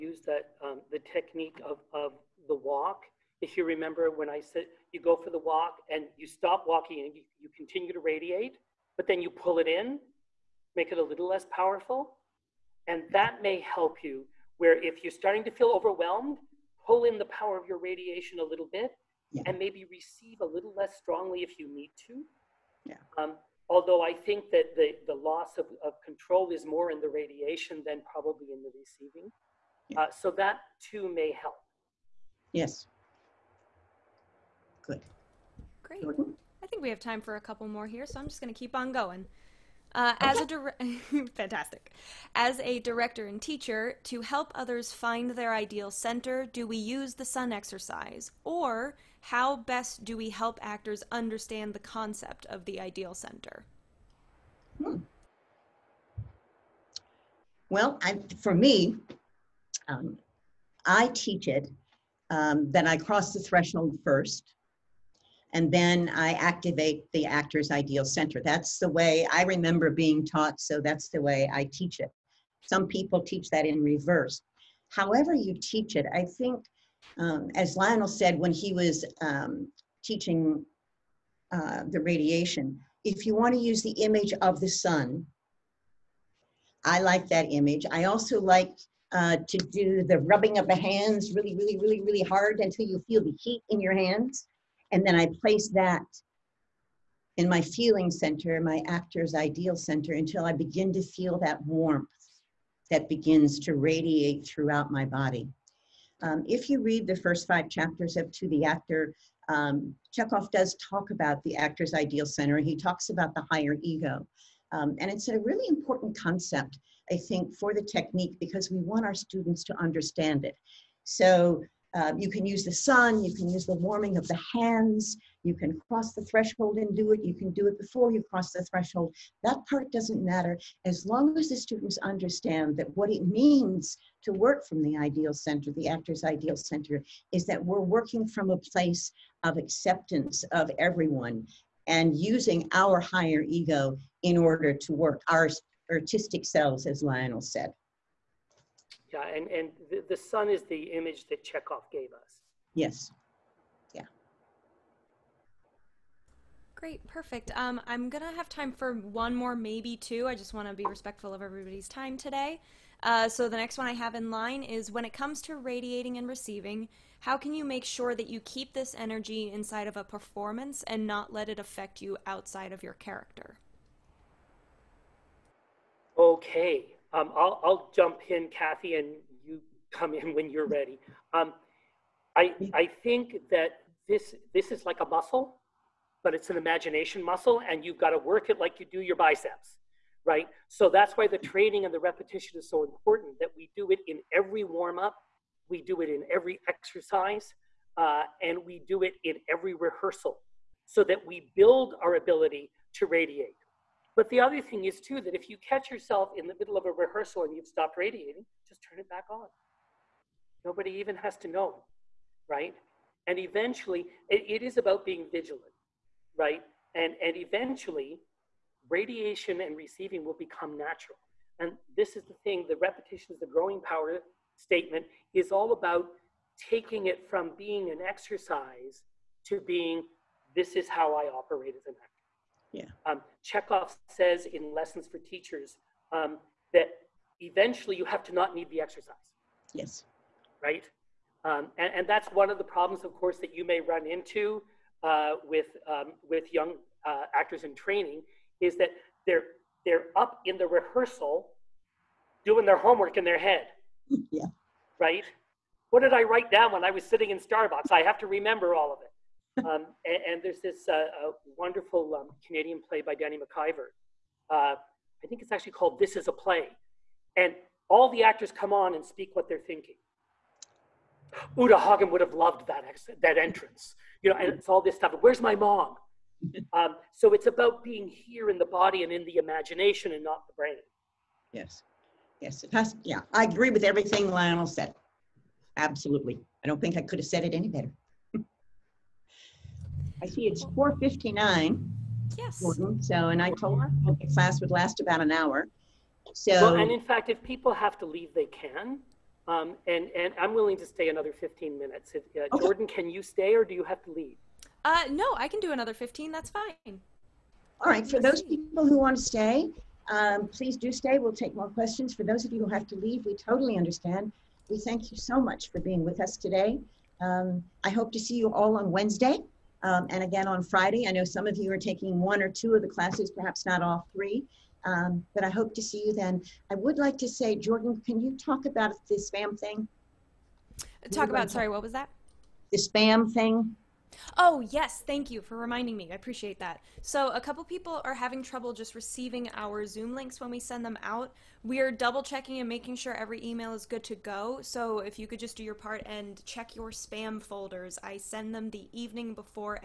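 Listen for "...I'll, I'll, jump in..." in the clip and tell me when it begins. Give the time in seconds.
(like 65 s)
177 s.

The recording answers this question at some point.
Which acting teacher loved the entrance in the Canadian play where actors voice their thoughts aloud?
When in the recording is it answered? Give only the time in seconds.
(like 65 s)
271 s.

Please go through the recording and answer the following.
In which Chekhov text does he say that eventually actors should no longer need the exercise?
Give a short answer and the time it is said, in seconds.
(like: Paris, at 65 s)
Lessons for Teachers, at 234 s.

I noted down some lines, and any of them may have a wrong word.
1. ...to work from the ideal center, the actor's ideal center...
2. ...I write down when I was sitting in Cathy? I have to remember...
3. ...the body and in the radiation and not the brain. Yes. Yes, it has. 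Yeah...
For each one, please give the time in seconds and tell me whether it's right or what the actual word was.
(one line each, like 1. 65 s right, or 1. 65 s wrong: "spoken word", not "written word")
1. 134 s right
2. 256 s wrong: "Starbucks", not "Cathy"
3. 278 s wrong: "imagination", not "radiation".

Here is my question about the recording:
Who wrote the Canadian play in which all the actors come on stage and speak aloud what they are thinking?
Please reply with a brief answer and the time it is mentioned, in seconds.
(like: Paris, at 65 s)
Danny MacIvor, at 263 s.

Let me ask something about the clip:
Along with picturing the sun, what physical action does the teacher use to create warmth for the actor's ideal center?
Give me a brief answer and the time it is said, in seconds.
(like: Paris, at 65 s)
Rubbing of the hands, at 90 s.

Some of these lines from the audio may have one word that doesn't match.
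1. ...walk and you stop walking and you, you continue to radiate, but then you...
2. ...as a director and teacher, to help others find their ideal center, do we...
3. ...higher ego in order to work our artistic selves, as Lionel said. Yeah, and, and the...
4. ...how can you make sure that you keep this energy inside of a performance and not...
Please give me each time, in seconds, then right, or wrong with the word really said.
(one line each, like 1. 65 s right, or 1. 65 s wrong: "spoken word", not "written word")
1. 5 s right
2. 42 s right
3. 143 s right
4. 167 s right.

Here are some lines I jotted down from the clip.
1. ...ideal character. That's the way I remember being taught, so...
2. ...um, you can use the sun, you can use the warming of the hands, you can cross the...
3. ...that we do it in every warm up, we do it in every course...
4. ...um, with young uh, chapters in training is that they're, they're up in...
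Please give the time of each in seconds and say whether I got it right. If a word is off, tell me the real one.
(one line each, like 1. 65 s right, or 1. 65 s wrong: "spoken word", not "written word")
1. 67 s wrong: "center", not "character"
2. 121 s right
3. 193 s wrong: "exercise", not "course"
4. 245 s wrong: "actors", not "chapters".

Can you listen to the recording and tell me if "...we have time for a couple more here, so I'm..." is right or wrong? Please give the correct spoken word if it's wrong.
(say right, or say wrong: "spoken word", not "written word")
right.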